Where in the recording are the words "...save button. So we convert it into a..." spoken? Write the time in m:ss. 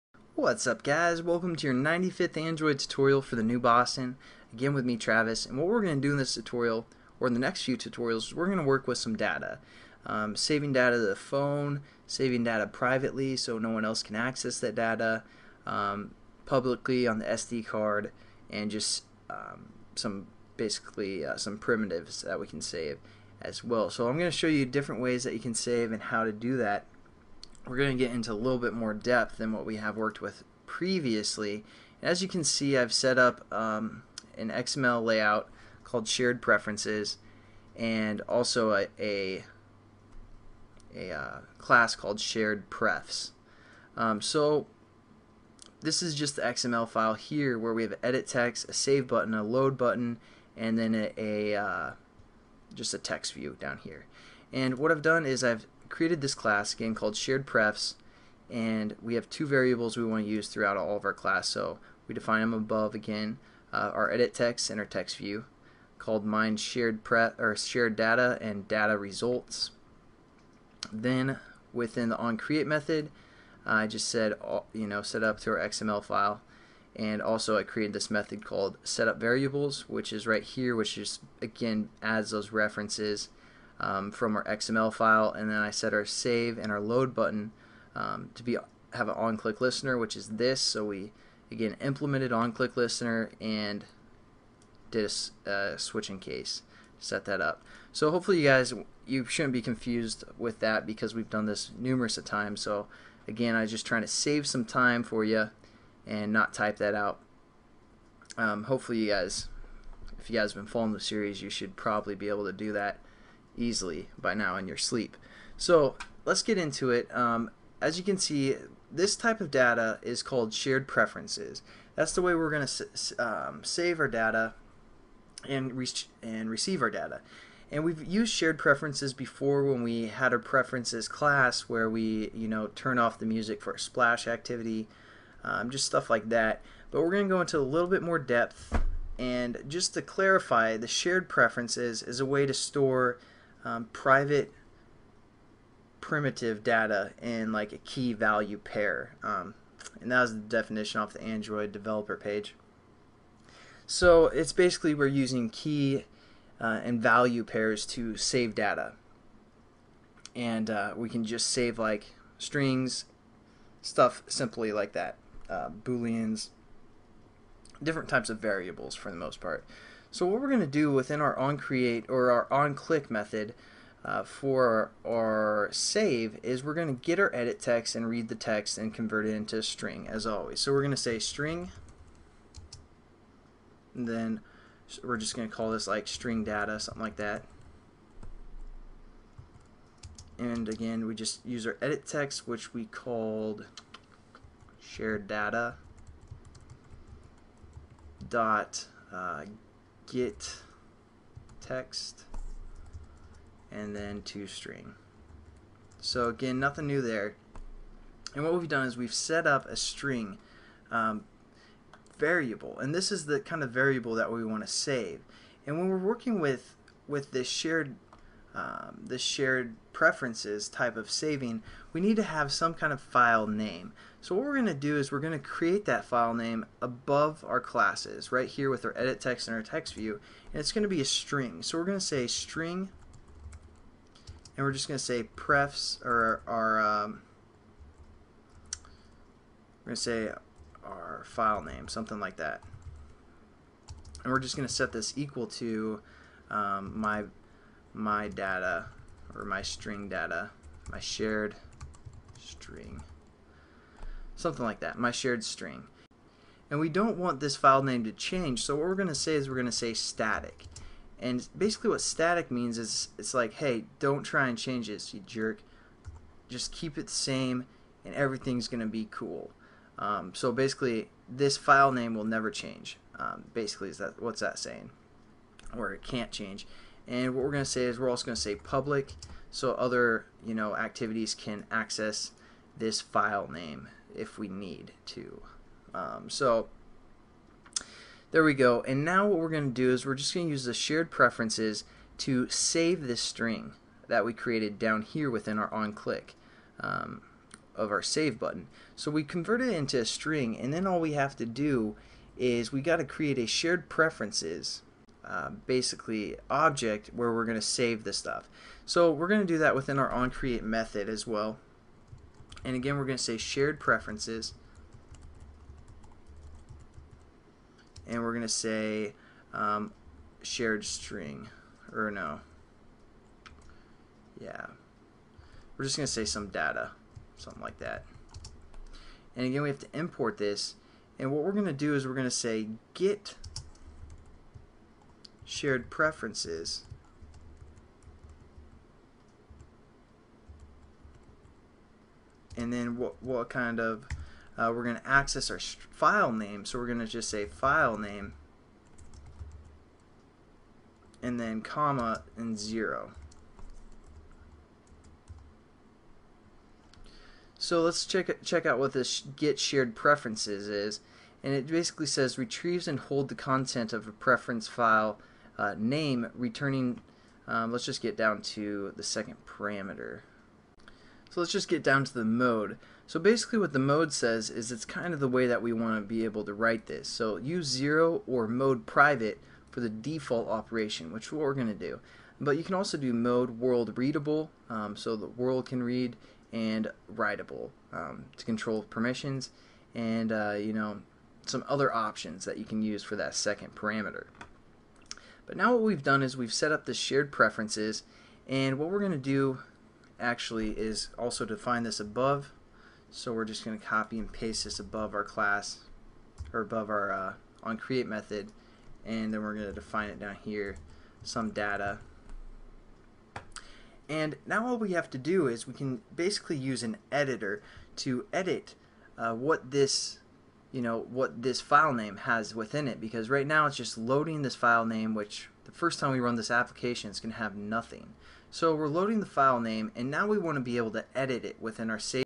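4:58.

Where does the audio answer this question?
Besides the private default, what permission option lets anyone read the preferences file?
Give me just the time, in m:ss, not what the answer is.
6:23.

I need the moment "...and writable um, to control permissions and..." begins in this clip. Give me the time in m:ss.
6:26.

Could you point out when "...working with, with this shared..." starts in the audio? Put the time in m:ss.
3:35.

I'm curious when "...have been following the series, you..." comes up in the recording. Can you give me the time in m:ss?
1:50.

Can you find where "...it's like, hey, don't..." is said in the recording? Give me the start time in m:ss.
4:23.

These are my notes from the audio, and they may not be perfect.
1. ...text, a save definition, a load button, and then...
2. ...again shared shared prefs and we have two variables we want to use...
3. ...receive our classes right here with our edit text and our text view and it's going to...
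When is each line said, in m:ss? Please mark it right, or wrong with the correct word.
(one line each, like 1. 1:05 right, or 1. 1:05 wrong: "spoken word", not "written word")
1. 0:48 wrong: "button", not "definition"
2. 0:56 wrong: "called", not "shared"
3. 3:46 wrong: "above", not "receive".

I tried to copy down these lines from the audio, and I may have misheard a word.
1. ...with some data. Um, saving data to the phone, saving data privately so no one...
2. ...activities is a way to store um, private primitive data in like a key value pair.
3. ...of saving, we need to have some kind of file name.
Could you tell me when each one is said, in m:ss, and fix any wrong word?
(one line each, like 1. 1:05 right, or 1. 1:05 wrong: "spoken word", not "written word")
1. 0:08 right
2. 2:21 wrong: "preferences", not "activities"
3. 3:40 right.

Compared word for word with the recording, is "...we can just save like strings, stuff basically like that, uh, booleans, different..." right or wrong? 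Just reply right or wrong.
wrong.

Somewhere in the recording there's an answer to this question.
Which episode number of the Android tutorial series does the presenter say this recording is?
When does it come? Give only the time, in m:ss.
0:01.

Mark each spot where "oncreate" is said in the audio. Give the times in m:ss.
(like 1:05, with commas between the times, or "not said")
2:51, 5:10.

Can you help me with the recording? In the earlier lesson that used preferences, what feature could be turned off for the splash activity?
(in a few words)
the music.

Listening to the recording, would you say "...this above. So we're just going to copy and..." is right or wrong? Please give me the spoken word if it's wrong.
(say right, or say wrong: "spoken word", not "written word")
right.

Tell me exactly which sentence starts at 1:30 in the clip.
So we again implemented on-click listener and did a uh, switching case, set that up.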